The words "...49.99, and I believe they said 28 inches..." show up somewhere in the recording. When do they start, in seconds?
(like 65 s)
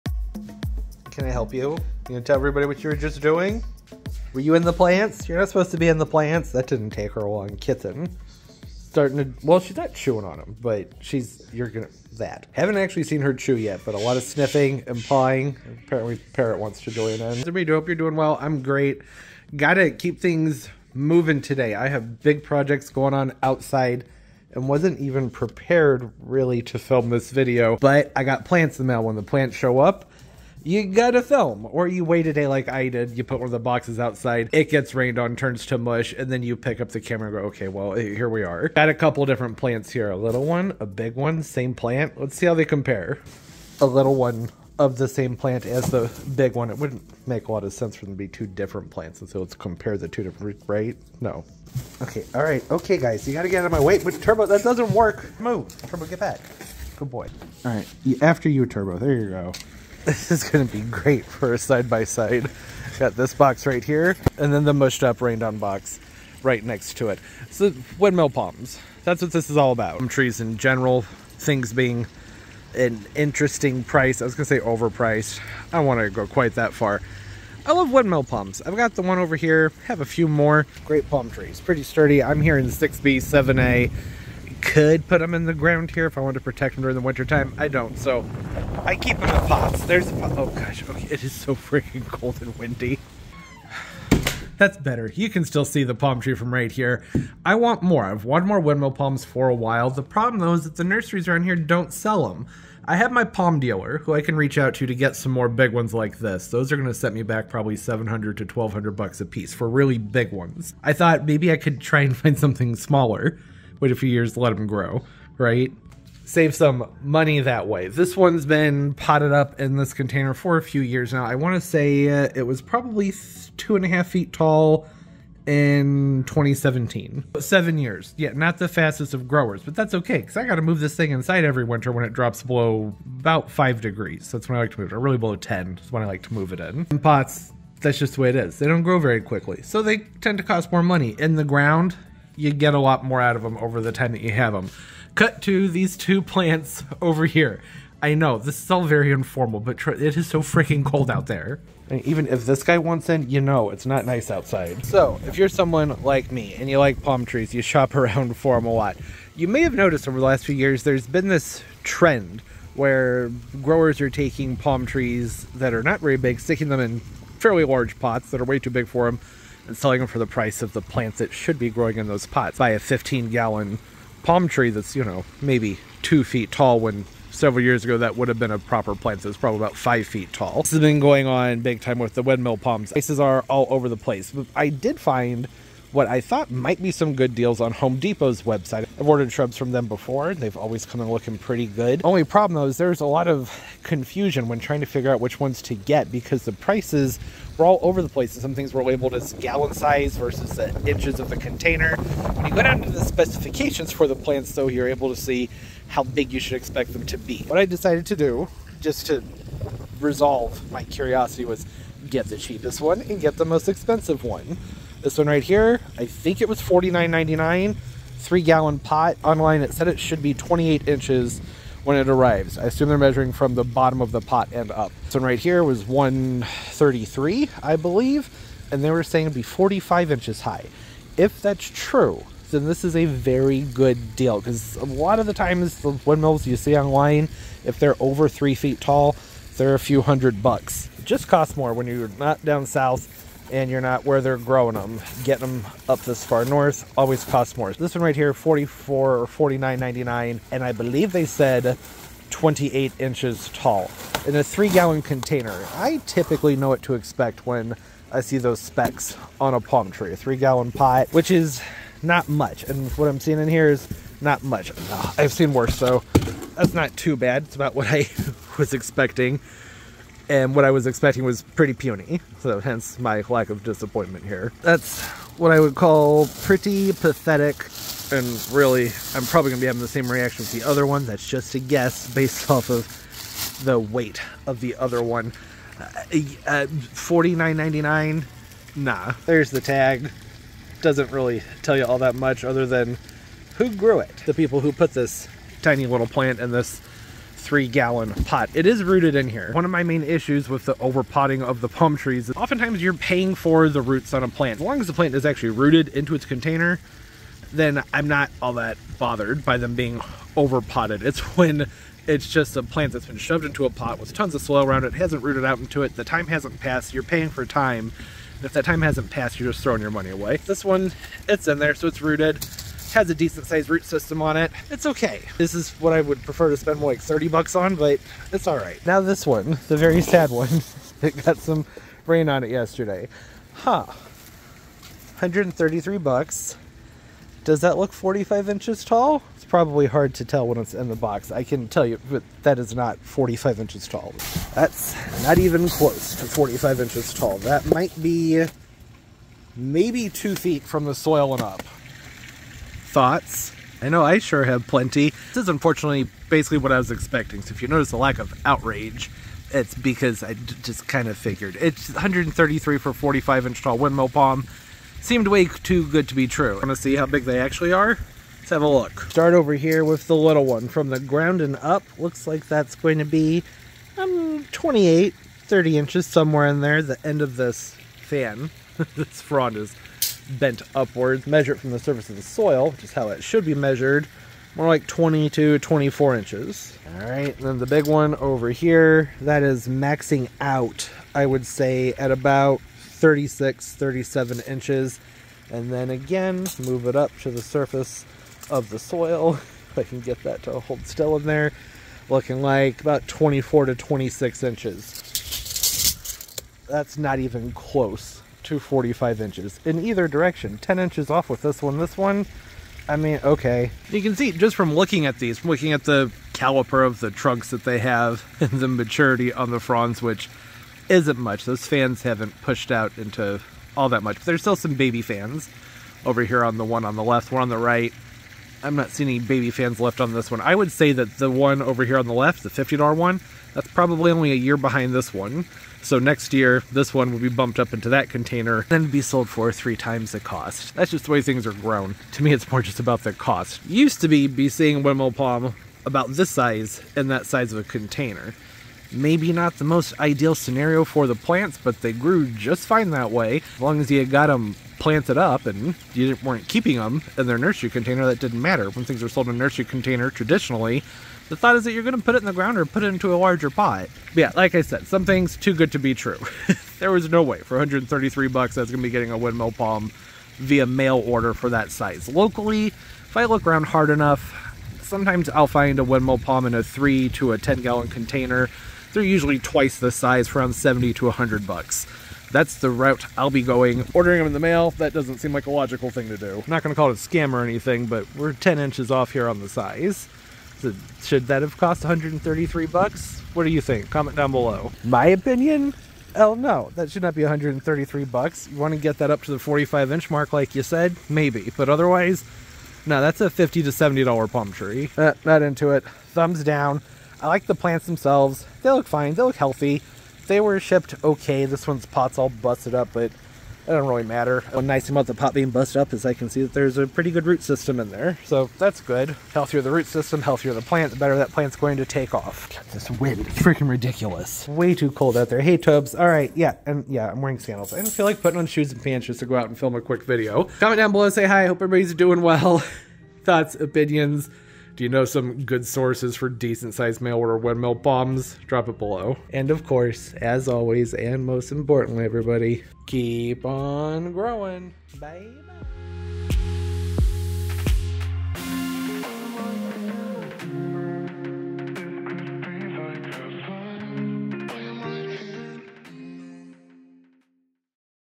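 249 s.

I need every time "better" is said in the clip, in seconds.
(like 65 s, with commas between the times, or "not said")
94 s, 520 s.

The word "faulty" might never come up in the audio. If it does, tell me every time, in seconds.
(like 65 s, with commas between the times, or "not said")
not said.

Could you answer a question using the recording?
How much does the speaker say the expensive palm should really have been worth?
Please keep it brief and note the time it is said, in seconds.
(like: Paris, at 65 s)
50 to 70 dollars, at 503 s.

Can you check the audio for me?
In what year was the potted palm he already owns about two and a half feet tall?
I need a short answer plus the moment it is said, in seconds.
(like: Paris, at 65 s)
2017, at 126 s.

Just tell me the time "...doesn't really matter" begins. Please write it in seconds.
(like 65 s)
513 s.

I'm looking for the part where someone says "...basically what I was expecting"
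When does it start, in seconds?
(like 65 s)
356 s.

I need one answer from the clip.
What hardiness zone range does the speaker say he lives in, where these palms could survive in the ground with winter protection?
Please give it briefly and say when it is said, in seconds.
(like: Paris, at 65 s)
6B, 7A, at 82 s.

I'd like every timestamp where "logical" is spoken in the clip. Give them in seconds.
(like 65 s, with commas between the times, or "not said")
485 s.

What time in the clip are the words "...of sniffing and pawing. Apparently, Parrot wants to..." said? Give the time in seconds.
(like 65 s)
14 s.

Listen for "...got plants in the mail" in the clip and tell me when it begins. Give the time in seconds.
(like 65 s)
28 s.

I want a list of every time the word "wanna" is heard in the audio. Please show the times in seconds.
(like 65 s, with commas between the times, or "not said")
75 s.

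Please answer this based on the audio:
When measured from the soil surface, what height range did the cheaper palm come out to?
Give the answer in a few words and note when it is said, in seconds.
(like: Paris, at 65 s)
20 to 24 inches, at 384 s.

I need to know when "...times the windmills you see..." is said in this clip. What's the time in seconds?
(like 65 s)
235 s.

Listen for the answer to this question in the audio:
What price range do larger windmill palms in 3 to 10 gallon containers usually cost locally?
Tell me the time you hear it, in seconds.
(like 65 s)
480 s.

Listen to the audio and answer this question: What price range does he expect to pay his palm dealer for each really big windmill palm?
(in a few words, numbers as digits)
700 to 1200 dollars.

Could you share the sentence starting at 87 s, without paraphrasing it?
I don't, so I keep them in pots.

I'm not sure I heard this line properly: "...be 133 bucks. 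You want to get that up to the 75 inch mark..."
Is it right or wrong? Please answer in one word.
wrong.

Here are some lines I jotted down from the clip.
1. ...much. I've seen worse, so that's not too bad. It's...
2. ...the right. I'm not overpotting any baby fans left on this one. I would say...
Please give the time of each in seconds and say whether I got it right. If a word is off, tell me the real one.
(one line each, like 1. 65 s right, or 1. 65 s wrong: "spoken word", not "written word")
1. 264 s right
2. 427 s wrong: "seeing", not "overpotting".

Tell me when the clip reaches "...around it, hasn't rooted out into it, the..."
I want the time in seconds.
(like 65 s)
314 s.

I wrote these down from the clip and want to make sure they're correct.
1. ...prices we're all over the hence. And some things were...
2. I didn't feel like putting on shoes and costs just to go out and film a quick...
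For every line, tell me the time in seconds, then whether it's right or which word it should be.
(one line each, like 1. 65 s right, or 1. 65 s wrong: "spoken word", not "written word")
1. 196 s wrong: "place", not "hence"
2. 527 s wrong: "pants", not "costs".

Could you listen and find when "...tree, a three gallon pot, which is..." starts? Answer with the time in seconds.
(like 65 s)
259 s.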